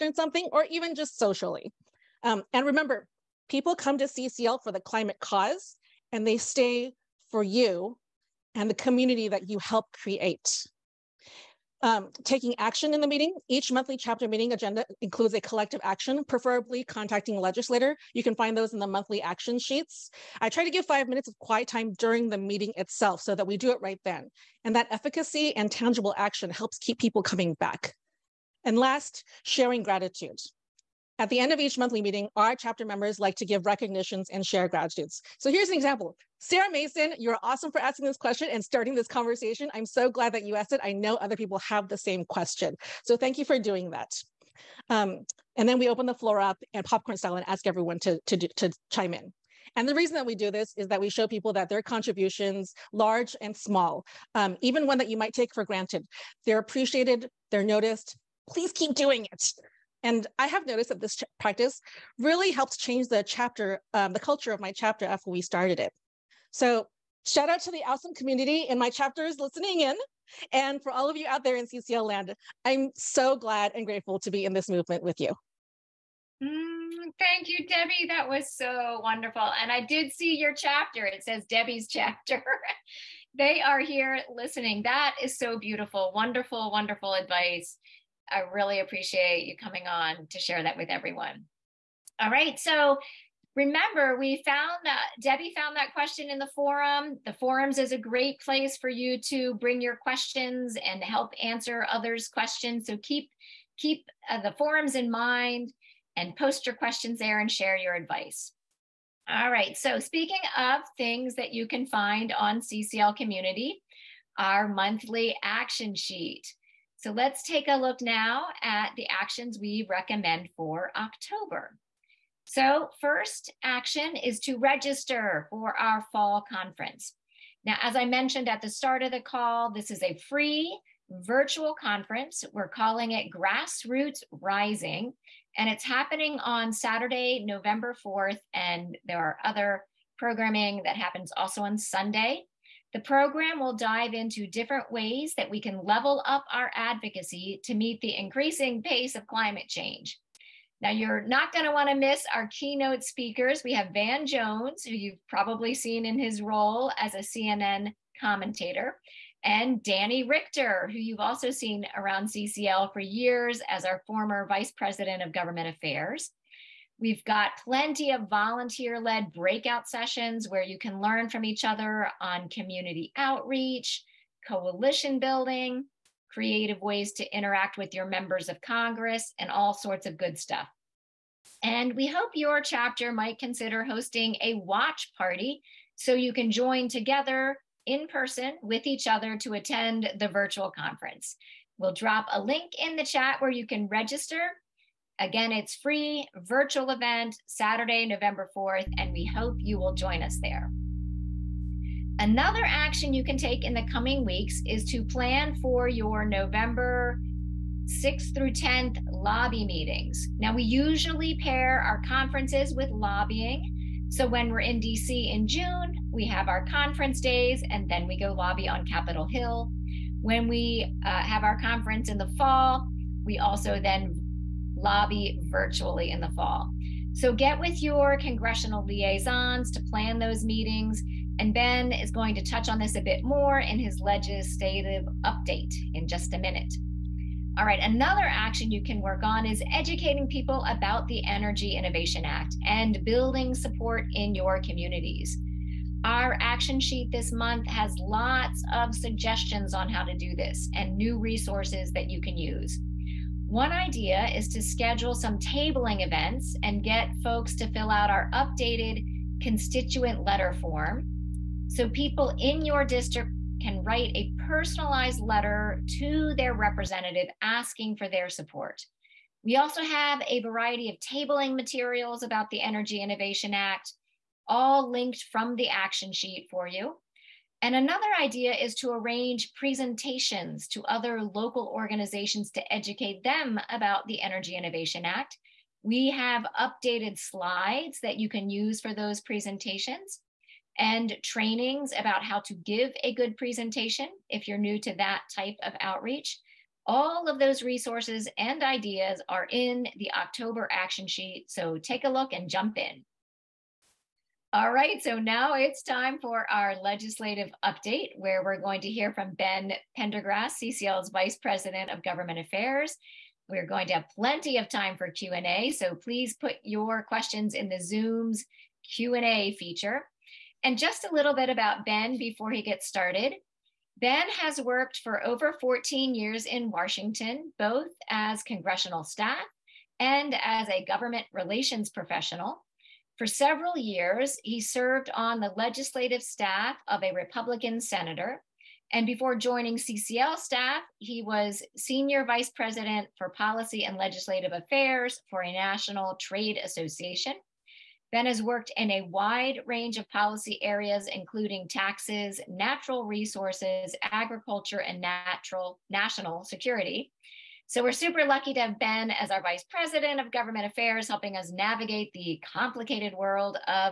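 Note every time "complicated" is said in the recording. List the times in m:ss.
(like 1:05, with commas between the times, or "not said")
6:02.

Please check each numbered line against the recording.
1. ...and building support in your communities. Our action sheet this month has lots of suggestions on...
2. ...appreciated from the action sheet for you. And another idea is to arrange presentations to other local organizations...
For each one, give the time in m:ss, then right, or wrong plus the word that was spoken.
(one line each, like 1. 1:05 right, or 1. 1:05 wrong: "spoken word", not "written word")
1. 4:02 right
2. 4:34 wrong: "linked", not "appreciated".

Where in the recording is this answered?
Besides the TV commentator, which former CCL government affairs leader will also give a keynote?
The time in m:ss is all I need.
2:39.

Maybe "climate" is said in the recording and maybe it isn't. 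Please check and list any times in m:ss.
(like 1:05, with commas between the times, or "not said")
0:04, 2:29.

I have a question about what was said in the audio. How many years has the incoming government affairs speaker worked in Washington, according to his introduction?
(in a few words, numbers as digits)
over 14 years.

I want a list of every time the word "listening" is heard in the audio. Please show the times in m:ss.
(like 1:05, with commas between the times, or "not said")
1:09, 1:24.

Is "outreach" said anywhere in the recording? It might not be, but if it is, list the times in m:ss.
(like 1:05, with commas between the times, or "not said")
2:53, 4:55.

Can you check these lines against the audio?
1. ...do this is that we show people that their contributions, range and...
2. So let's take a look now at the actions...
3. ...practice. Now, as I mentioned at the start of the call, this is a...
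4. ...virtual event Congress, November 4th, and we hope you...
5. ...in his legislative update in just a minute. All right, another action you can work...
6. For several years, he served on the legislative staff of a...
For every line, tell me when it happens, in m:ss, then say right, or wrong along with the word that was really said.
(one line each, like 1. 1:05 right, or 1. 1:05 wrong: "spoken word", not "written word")
1. 0:50 wrong: "large", not "range"
2. 1:57 right
3. 2:06 wrong: "conference", not "practice"
4. 3:16 wrong: "Saturday", not "Congress"
5. 3:53 right
6. 5:33 right.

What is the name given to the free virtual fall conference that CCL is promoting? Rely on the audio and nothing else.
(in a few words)
Grassroots Rising.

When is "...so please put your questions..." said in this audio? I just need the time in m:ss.
5:15.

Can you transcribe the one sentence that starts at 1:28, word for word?
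I really appreciate you coming on to share that with everyone.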